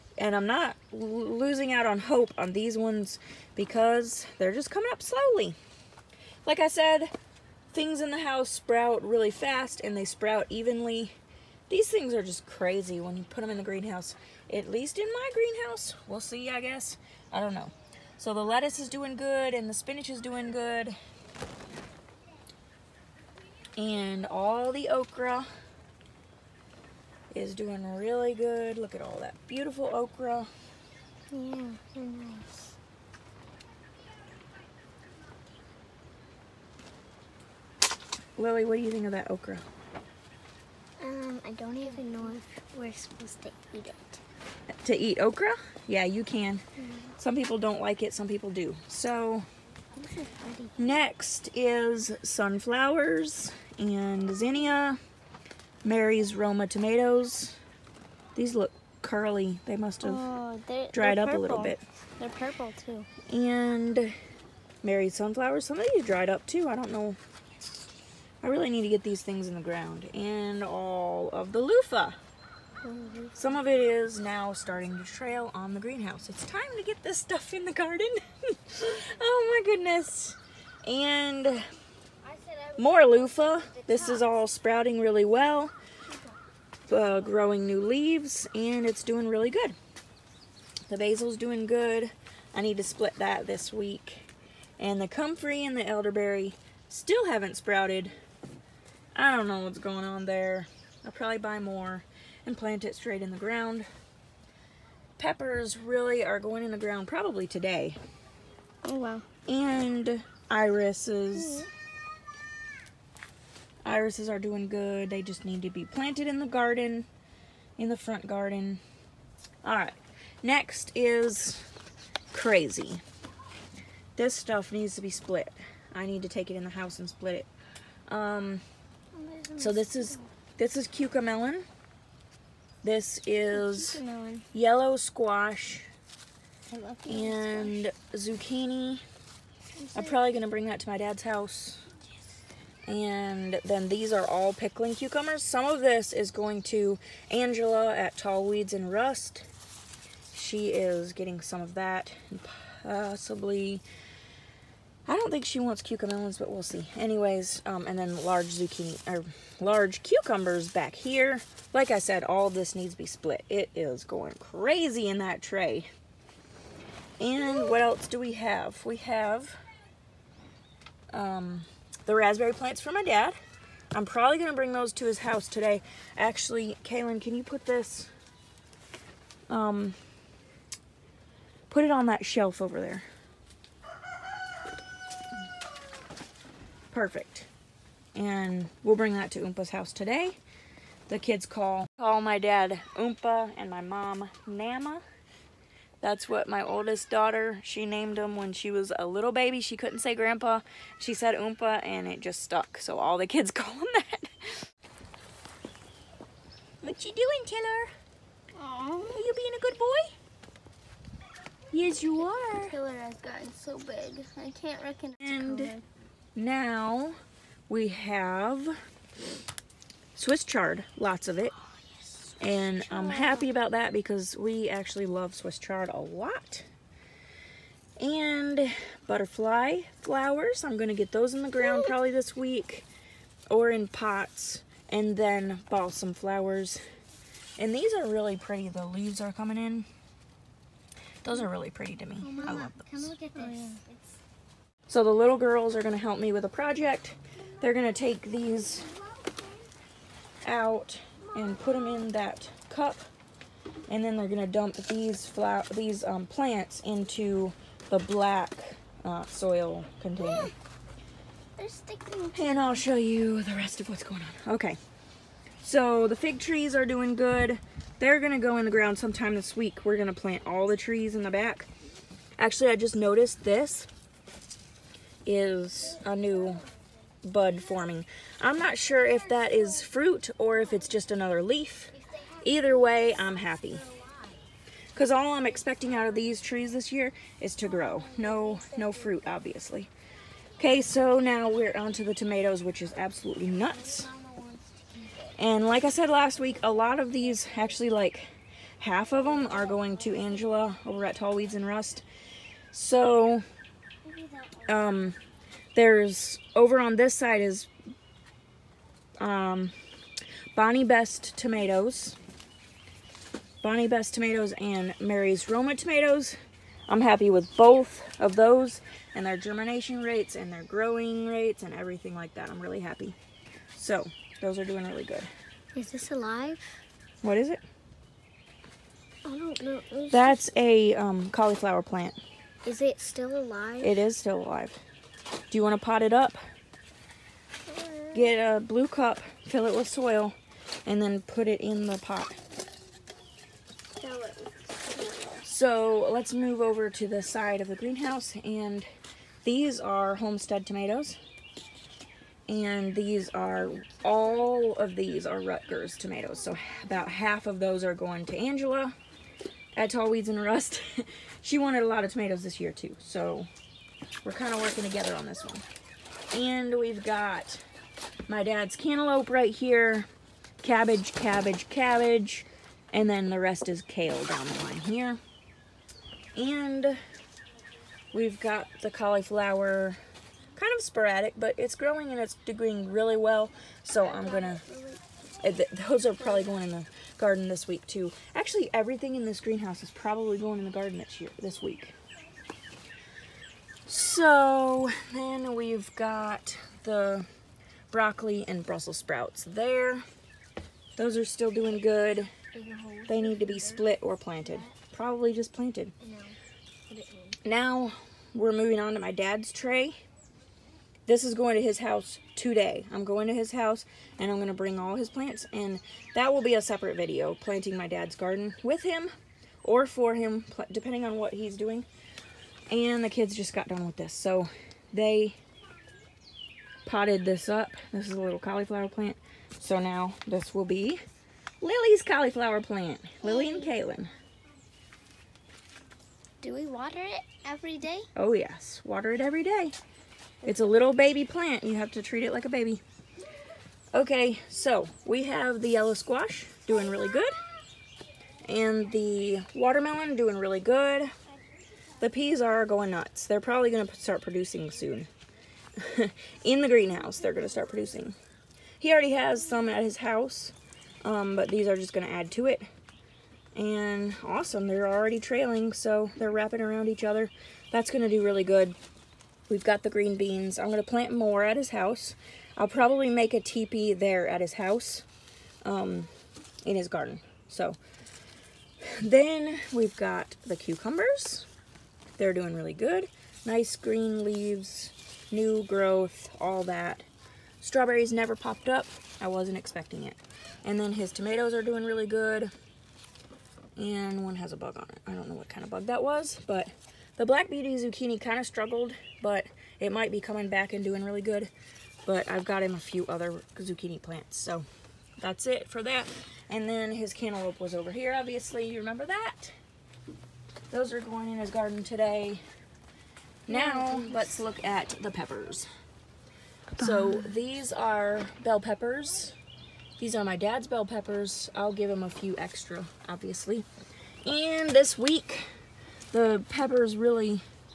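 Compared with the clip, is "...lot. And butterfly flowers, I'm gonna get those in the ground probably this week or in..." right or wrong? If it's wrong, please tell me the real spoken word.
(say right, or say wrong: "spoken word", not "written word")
right.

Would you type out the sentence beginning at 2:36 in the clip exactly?
Anyways, um, and then large zucchini, or large cucumbers back here.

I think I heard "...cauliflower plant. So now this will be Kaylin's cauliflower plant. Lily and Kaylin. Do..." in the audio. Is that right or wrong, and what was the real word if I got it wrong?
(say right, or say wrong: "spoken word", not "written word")
wrong: "Lily", not "Kaylin".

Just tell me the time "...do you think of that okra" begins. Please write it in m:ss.
0:38.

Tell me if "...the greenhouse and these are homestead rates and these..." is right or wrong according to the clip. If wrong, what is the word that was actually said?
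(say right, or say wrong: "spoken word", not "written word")
wrong: "tomatoes", not "rates".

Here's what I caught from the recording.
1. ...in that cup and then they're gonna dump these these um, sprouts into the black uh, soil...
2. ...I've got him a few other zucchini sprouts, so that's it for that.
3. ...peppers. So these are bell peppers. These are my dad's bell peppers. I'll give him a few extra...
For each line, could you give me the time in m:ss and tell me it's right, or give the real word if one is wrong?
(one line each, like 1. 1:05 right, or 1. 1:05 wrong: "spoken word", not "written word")
1. 4:11 wrong: "plants", not "sprouts"
2. 8:22 wrong: "plants", not "sprouts"
3. 8:35 right.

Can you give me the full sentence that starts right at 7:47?
That's going to do really good.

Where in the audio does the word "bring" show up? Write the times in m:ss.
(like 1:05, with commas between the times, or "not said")
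2:20, 2:54, 3:08, 6:54.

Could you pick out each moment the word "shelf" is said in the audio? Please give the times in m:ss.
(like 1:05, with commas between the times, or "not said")
3:02.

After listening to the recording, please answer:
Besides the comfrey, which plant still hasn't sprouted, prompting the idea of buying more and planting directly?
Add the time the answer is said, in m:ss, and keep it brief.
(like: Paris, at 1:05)
elderberry, at 1:35.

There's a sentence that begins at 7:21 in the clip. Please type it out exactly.
You have to treat it like a baby.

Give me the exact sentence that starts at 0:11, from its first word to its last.
These things are just crazy when you put them in the greenhouse.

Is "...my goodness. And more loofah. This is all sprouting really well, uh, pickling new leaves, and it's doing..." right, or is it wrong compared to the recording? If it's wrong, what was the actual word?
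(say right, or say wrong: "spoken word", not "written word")
wrong: "growing", not "pickling".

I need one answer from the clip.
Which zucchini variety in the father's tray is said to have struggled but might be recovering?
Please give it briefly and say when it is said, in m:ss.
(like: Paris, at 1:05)
black beauty, at 8:17.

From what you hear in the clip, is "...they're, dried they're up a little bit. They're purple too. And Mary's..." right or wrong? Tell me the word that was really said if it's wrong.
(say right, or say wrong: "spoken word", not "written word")
right.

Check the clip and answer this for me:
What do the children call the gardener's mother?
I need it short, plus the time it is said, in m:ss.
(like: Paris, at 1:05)
Nama, at 3:14.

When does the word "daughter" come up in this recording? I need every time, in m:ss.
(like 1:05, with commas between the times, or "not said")
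3:17.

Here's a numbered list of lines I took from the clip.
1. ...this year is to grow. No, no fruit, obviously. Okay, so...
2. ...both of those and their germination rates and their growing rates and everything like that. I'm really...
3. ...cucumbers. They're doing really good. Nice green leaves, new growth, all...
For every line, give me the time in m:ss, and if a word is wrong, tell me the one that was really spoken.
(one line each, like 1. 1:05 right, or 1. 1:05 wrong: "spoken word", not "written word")
1. 4:46 right
2. 5:17 right
3. 8:00 right.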